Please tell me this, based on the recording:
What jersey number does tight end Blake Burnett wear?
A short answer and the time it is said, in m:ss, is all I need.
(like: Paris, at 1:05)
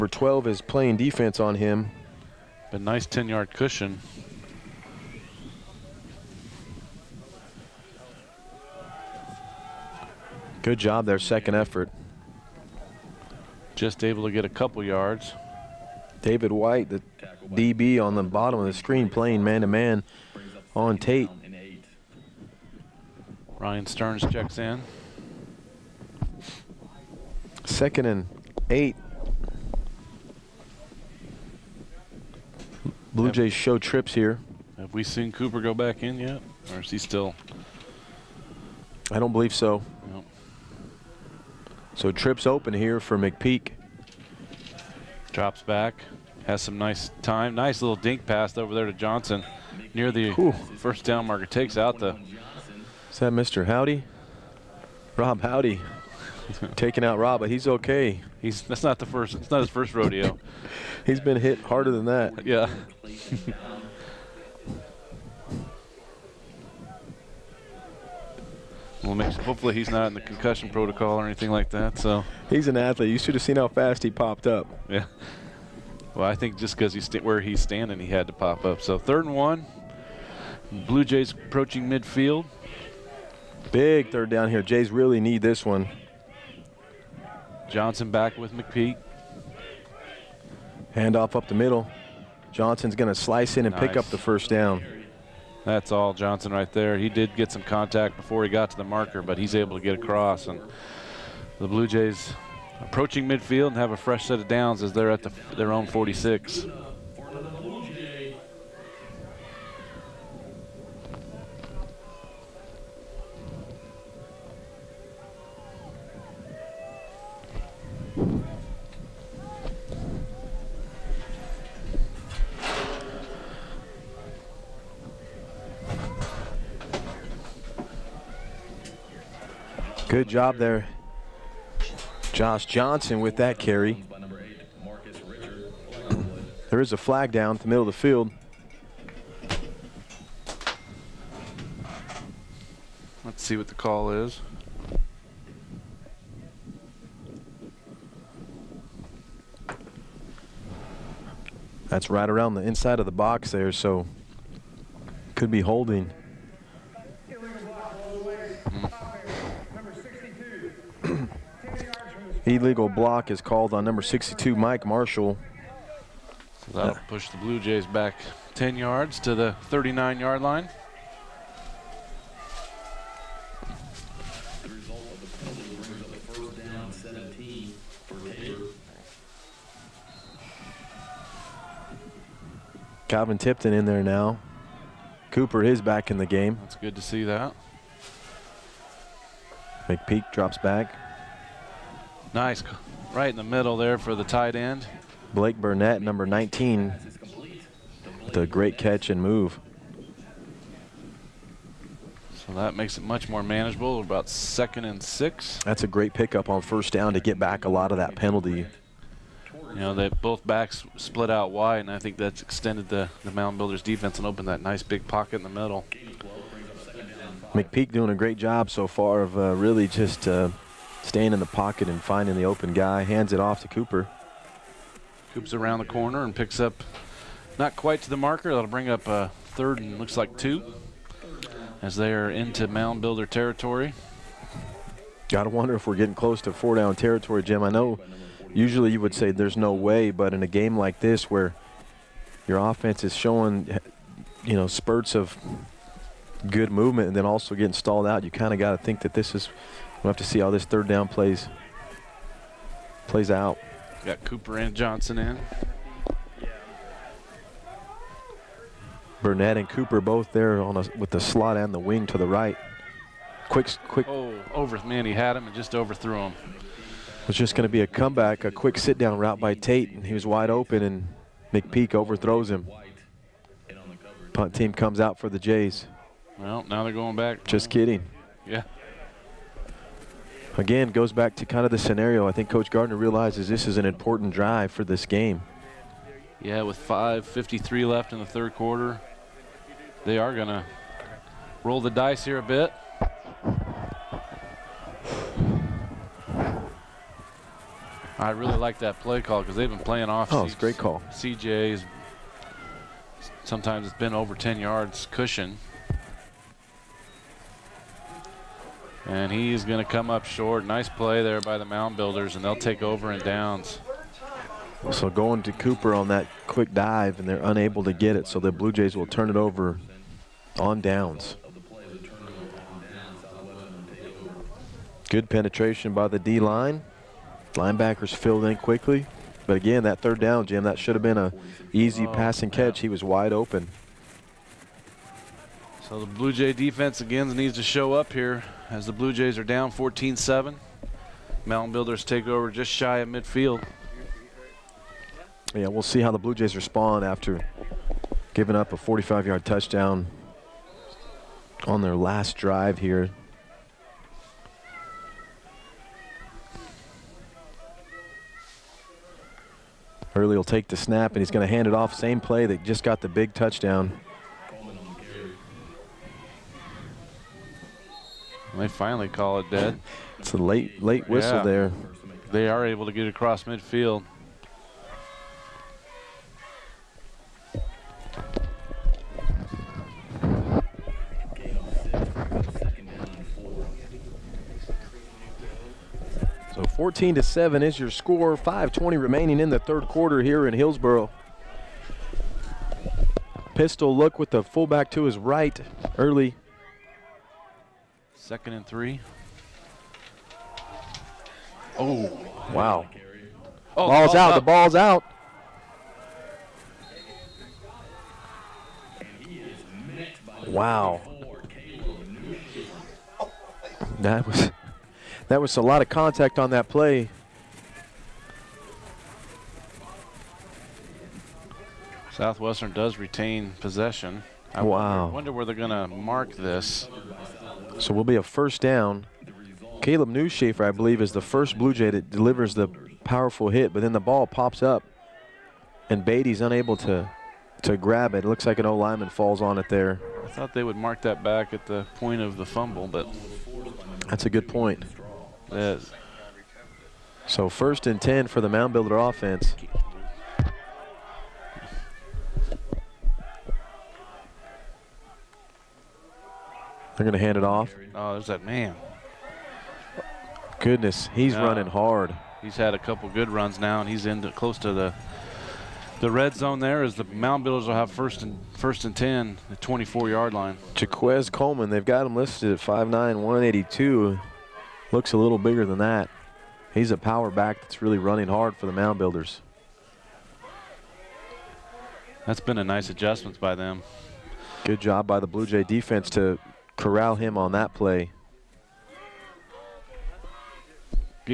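19, at 3:16.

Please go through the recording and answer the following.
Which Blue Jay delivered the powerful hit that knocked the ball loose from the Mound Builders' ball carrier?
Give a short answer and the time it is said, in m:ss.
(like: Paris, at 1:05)
Caleb Newshafer, at 7:09.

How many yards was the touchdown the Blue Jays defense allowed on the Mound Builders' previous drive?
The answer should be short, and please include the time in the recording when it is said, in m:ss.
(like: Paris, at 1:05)
45, at 5:48.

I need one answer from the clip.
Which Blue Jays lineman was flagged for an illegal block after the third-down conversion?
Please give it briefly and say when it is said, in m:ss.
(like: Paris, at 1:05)
Mike Marshall, at 2:44.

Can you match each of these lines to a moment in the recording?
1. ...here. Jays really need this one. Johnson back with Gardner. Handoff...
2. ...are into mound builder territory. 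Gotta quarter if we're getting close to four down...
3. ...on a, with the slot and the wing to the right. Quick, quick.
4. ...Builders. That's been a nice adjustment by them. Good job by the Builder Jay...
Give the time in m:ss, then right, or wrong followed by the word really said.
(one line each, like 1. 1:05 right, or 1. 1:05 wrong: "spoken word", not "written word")
1. 1:24 wrong: "McPeak", not "Gardner"
2. 3:52 wrong: "wonder", not "quarter"
3. 4:20 right
4. 7:58 wrong: "Blue", not "Builder".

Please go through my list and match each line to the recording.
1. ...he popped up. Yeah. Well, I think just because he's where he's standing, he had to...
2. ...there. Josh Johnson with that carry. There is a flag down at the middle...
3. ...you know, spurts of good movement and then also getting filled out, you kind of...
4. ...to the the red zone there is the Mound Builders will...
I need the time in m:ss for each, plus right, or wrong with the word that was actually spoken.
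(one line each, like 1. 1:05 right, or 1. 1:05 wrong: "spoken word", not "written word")
1. 1:14 right
2. 2:10 right
3. 4:04 wrong: "stalled", not "filled"
4. 7:44 right.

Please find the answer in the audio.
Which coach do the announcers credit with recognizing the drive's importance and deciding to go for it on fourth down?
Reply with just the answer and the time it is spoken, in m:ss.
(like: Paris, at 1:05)
Coach Gardner, at 4:42.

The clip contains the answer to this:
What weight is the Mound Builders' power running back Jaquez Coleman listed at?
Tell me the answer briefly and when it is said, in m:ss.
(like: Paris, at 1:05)
182, at 7:52.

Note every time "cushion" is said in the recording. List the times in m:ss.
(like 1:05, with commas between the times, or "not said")
0:03, 5:05.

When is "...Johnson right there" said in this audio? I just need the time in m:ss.
1:36.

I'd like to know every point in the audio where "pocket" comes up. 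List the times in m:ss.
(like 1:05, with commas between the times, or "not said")
3:35, 3:41.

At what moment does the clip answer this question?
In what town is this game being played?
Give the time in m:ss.
6:30.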